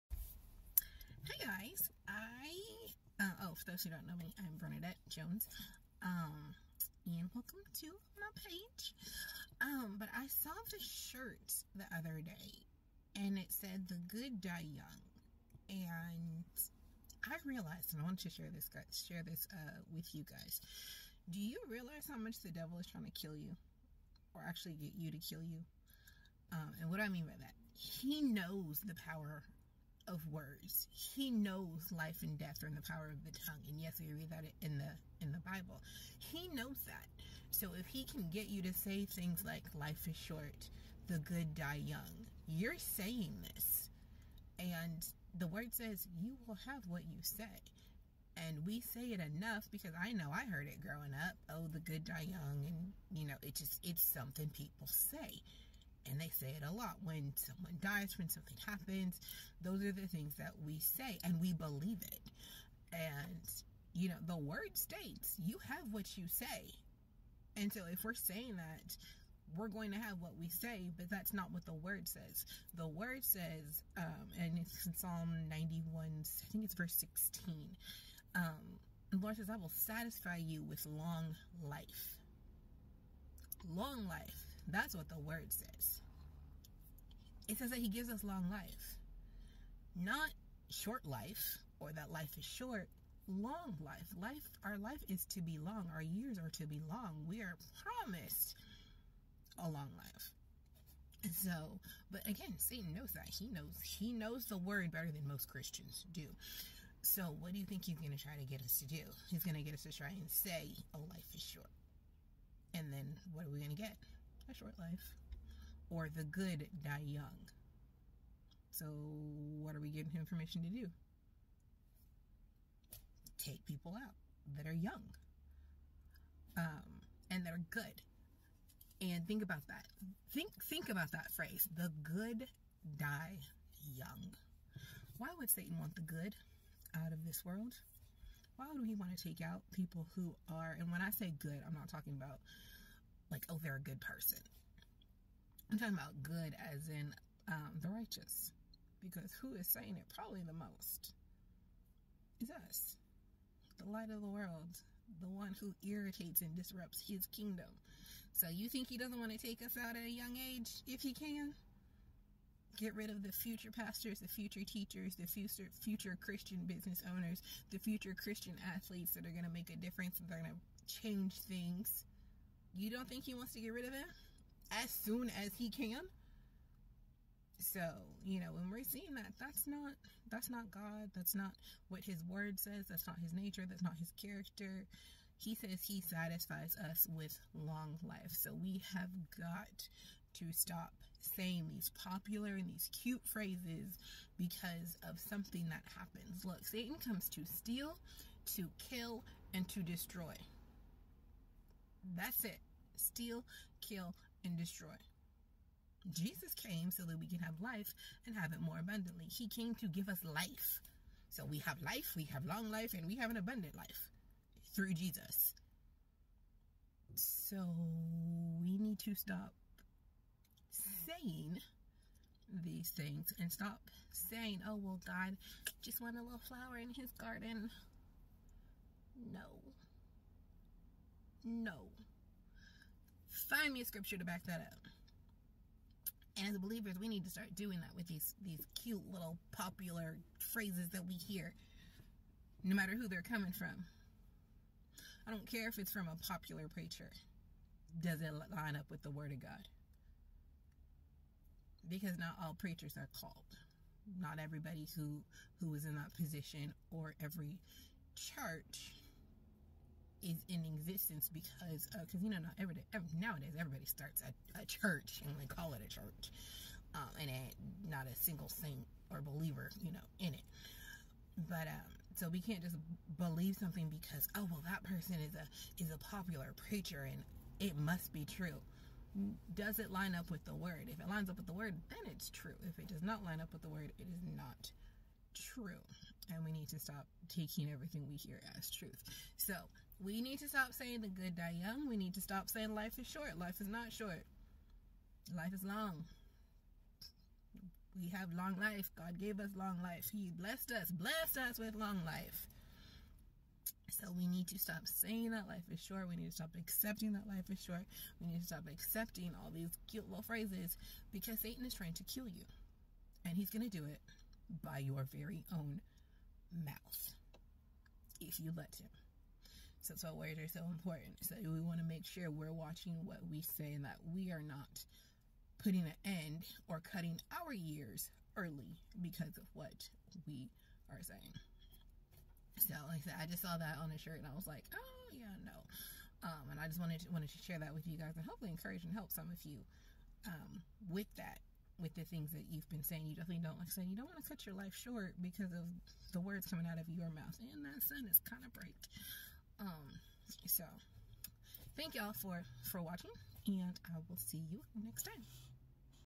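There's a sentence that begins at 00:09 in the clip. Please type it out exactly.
Um, but I saw this shirt the other day and it said The Good Die Young.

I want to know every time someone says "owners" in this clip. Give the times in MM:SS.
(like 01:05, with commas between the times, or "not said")
02:47.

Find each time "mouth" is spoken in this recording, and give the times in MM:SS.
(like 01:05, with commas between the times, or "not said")
05:16, 05:47.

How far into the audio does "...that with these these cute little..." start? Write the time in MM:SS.
03:57.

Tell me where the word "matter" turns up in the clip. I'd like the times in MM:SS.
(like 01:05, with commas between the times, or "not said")
04:02.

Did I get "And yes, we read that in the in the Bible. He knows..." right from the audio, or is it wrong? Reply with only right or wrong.
right.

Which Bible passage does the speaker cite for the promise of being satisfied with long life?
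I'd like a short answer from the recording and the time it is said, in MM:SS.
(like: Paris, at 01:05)
Psalm 91, at 01:14.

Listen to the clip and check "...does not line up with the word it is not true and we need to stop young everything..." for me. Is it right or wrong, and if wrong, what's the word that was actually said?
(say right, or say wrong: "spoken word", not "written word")
wrong: "taking", not "young".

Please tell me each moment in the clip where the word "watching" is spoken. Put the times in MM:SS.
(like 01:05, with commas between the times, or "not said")
05:22, 05:52.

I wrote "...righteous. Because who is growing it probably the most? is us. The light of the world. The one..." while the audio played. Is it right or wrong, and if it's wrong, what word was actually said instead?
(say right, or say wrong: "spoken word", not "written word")
wrong: "saying", not "growing".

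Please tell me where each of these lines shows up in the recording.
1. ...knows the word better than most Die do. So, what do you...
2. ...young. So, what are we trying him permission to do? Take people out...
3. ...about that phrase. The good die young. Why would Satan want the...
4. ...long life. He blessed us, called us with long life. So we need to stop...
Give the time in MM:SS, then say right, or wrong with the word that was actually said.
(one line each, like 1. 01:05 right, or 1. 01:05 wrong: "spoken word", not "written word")
1. 01:44 wrong: "Christians", not "Die"
2. 01:57 wrong: "giving", not "trying"
3. 02:10 right
4. 04:59 wrong: "blessed", not "called".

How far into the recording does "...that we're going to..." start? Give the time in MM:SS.
01:08.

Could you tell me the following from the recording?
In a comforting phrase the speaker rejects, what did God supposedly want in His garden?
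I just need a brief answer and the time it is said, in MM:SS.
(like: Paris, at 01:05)
a little flower, at 03:46.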